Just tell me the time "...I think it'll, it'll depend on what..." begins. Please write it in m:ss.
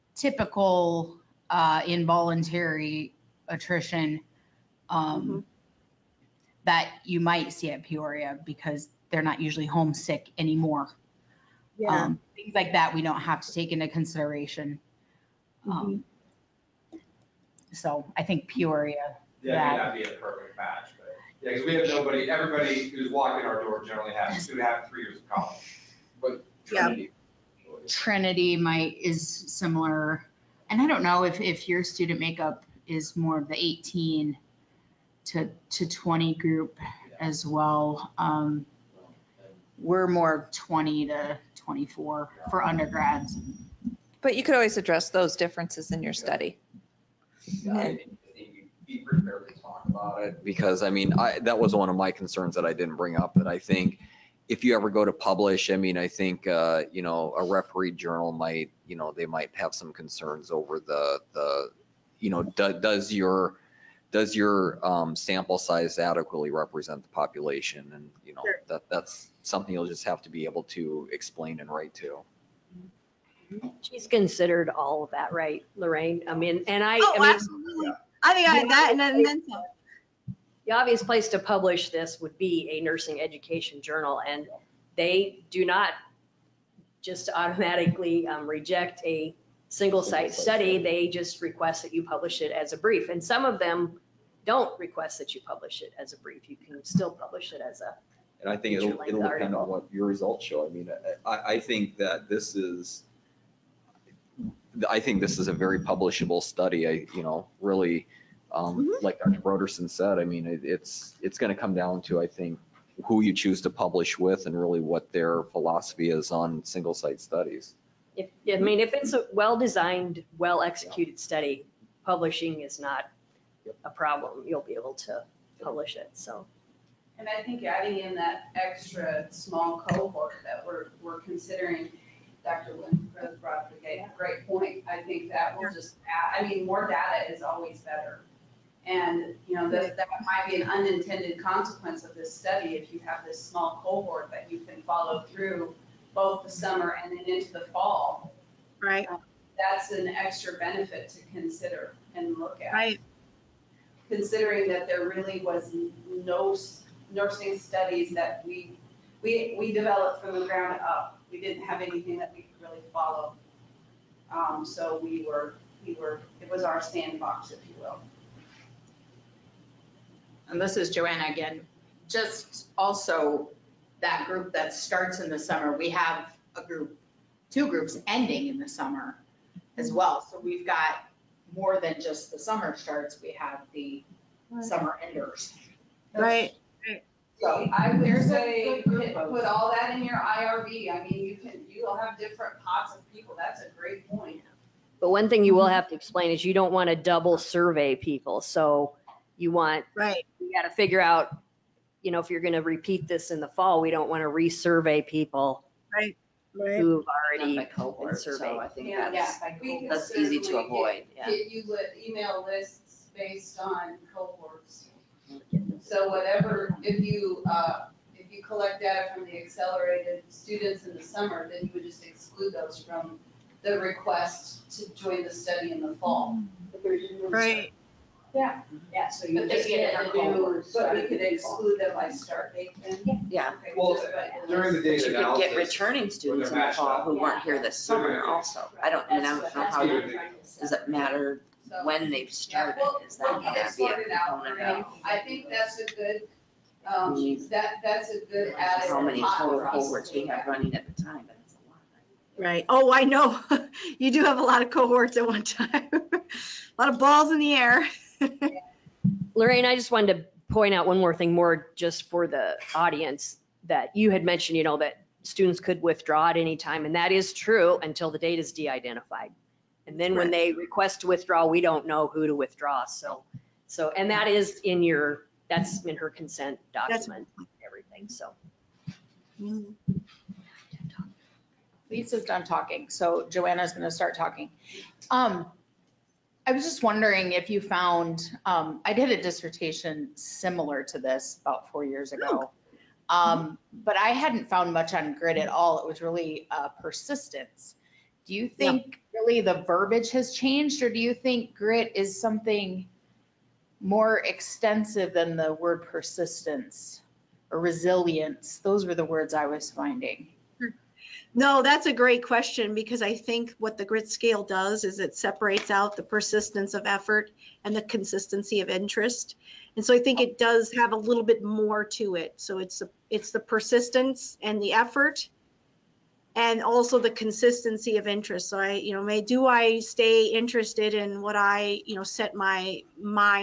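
1:38.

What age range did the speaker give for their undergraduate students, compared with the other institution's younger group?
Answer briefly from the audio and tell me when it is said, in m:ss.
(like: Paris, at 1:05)
20 to 24, at 0:40.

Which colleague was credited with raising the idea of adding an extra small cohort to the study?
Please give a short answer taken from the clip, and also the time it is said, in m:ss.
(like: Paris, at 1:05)
Dr. Lindgren, at 2:12.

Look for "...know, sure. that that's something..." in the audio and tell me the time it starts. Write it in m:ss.
1:08.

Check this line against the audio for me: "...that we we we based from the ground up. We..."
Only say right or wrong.
wrong.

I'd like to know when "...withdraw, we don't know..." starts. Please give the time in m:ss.
4:31.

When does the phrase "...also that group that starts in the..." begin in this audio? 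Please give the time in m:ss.
2:52.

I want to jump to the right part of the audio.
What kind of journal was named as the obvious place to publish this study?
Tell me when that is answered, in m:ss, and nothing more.
1:22.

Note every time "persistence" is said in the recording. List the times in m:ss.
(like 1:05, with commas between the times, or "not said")
4:56, 5:05, 5:16, 5:23.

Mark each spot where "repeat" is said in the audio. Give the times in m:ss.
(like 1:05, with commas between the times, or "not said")
3:22.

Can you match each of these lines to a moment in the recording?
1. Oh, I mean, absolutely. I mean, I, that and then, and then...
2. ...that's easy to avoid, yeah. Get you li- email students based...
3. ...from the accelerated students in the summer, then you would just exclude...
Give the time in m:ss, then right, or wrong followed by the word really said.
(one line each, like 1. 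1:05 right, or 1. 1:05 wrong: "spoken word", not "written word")
1. 1:17 right
2. 3:29 wrong: "lists", not "students"
3. 3:39 right.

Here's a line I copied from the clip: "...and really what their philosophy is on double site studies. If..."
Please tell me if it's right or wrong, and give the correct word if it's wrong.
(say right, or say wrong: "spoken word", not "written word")
wrong: "single", not "double".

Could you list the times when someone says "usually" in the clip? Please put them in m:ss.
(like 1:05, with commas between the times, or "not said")
0:09.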